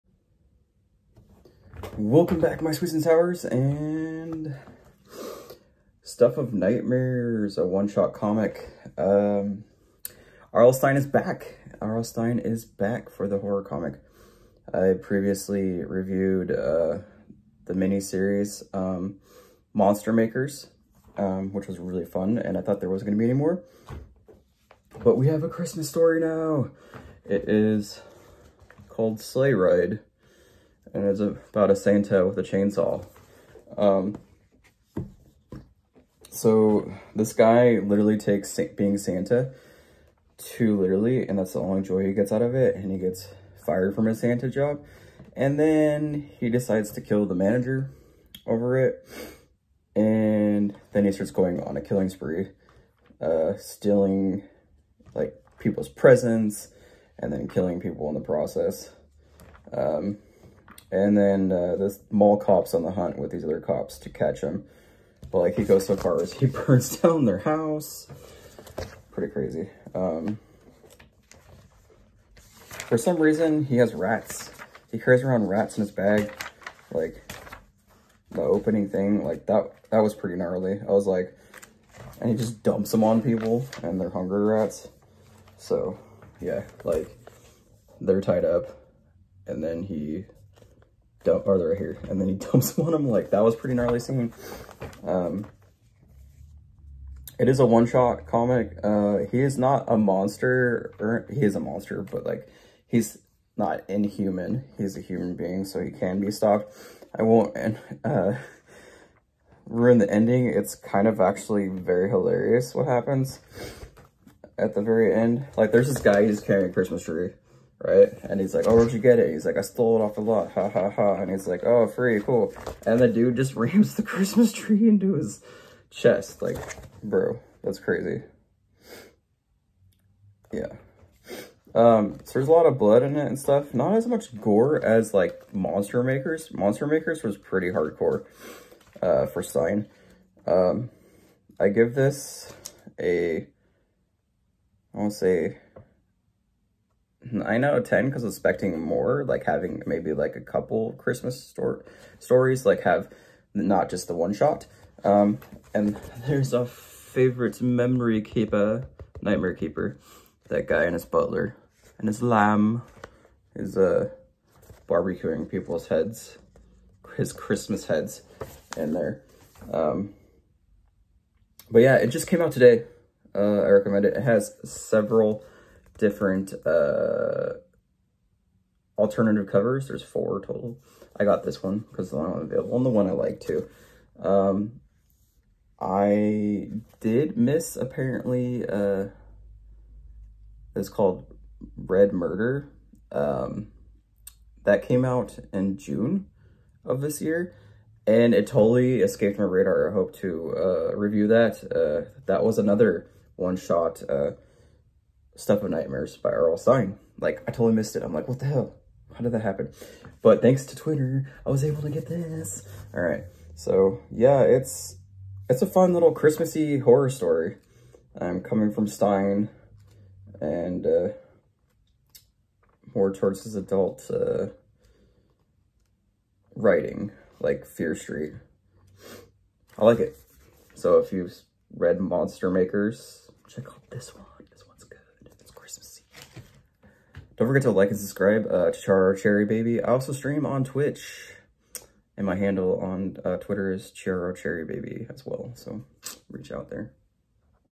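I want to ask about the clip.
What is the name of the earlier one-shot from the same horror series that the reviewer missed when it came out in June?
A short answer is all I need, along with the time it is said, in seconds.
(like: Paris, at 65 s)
Red Murder, at 191 s.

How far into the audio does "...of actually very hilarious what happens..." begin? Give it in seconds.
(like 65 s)
111 s.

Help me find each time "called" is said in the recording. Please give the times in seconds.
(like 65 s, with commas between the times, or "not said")
28 s, 190 s.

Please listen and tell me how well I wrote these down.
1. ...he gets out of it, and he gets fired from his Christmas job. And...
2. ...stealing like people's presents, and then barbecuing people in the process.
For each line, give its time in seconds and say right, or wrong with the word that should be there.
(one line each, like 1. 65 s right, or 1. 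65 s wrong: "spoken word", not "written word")
1. 42 s wrong: "Santa", not "Christmas"
2. 53 s wrong: "killing", not "barbecuing".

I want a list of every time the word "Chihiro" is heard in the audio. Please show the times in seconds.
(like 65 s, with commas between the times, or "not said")
238 s, 243 s.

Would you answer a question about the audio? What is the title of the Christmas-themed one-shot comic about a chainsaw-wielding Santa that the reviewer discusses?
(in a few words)
Slay Ride.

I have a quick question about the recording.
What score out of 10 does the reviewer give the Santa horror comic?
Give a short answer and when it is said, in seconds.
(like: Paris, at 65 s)
9, at 147 s.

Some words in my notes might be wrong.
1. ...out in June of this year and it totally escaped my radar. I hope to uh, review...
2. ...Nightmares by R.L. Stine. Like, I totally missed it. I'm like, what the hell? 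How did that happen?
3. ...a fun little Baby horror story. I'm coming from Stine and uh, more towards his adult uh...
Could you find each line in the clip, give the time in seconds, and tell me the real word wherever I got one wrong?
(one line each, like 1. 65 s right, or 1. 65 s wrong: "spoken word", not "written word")
1. 195 s right
2. 205 s right
3. 215 s wrong: "Christmassy", not "Baby".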